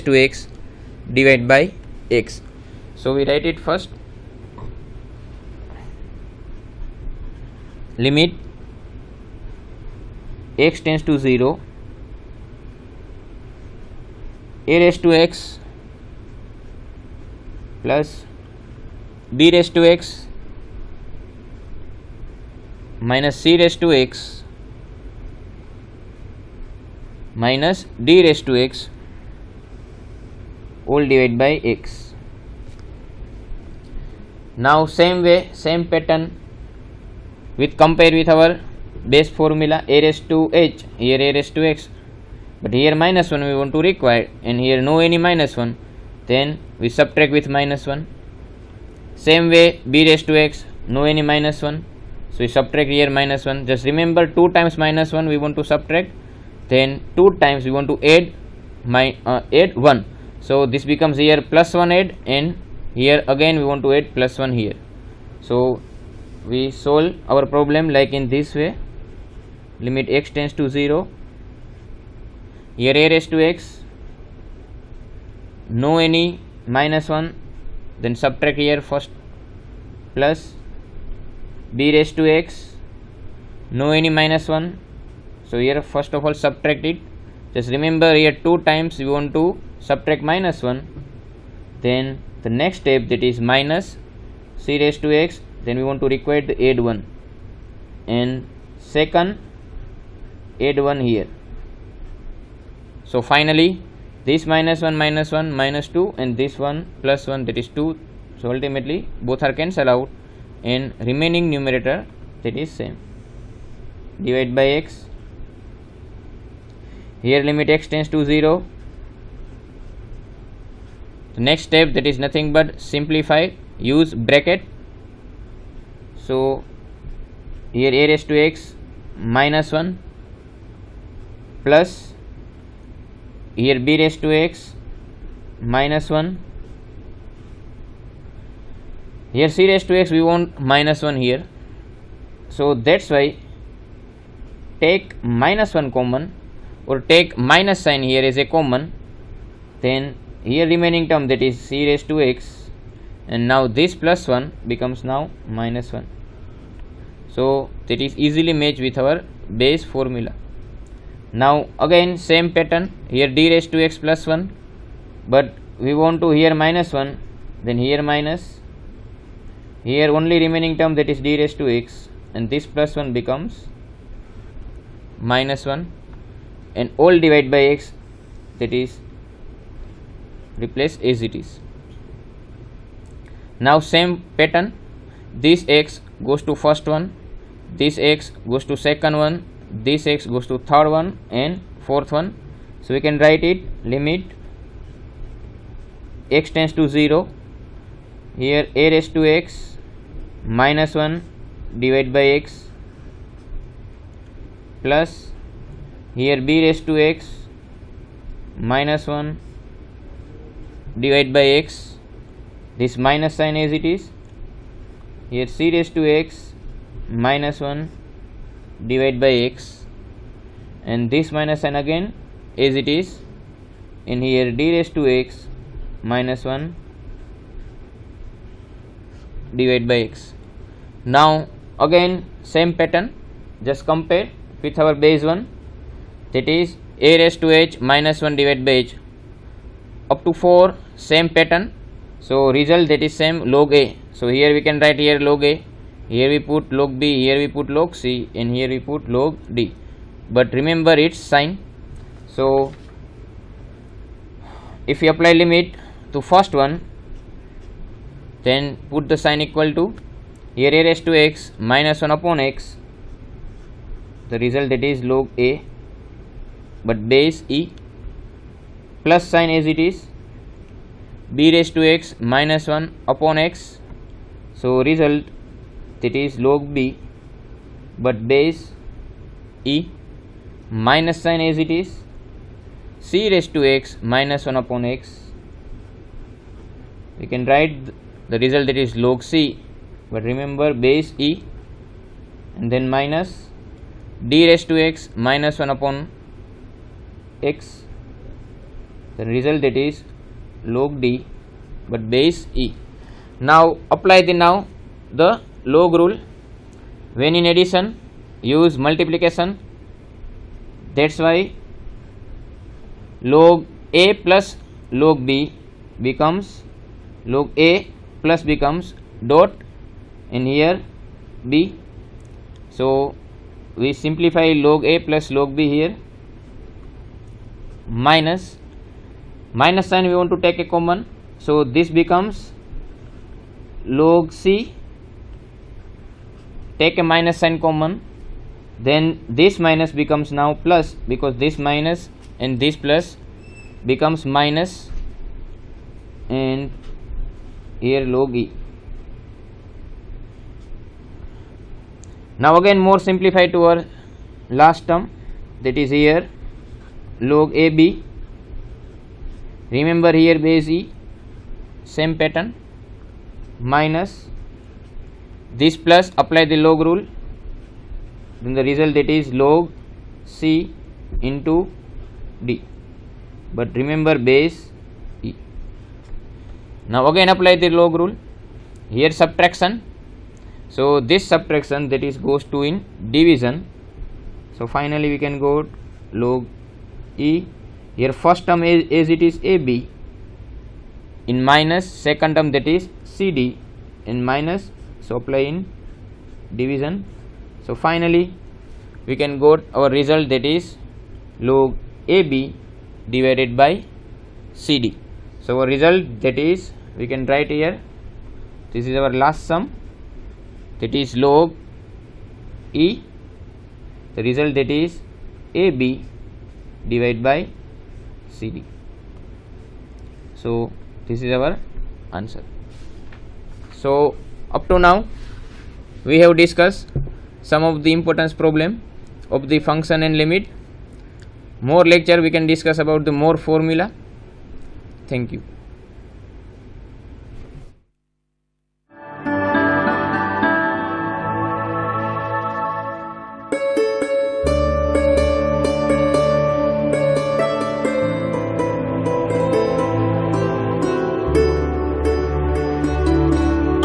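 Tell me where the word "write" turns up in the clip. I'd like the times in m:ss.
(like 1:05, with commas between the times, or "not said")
0:03, 3:13, 4:04, 4:47, 6:47.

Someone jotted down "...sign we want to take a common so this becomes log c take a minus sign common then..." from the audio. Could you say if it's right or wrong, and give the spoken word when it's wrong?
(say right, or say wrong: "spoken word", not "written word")
right.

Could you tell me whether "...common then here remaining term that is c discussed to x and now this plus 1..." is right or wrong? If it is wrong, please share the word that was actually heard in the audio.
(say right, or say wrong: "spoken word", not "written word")
wrong: "raised", not "discussed".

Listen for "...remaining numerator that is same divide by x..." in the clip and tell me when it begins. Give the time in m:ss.
1:51.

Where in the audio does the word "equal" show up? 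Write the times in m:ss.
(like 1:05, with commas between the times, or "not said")
4:19.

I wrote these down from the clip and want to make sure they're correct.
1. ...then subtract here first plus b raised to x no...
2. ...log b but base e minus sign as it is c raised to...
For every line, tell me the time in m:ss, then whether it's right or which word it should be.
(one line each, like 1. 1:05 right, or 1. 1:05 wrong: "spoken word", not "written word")
1. 1:18 right
2. 4:36 right.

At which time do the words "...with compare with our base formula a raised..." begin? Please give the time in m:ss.
0:37.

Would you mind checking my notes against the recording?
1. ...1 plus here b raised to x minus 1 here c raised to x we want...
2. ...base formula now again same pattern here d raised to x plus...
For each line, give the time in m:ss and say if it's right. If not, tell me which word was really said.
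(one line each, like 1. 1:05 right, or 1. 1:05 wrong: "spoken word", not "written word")
1. 2:09 right
2. 2:39 right.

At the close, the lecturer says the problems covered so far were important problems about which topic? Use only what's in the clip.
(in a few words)
function and limit.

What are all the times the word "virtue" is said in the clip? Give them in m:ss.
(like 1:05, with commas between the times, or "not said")
not said.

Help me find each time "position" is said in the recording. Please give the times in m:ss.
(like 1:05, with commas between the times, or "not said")
not said.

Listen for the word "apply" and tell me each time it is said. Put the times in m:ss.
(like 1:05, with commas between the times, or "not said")
4:15, 5:03, 6:06, 6:17, 6:35.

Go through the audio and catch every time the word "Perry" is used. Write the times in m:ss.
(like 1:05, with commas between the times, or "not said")
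not said.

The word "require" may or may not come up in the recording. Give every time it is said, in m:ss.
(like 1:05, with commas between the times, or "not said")
0:43, 1:36.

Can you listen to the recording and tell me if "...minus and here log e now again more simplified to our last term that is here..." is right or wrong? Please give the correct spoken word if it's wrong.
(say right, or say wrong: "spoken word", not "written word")
right.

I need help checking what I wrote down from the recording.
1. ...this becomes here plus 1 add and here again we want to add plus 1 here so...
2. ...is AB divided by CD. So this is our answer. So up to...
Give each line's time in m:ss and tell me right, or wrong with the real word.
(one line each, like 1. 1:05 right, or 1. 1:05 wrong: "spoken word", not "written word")
1. 1:00 right
2. 6:54 right.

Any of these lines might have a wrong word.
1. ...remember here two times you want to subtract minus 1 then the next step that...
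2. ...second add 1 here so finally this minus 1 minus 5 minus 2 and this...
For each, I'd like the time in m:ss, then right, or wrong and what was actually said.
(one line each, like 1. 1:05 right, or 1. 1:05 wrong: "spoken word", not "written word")
1. 1:27 right
2. 1:38 wrong: "1", not "5".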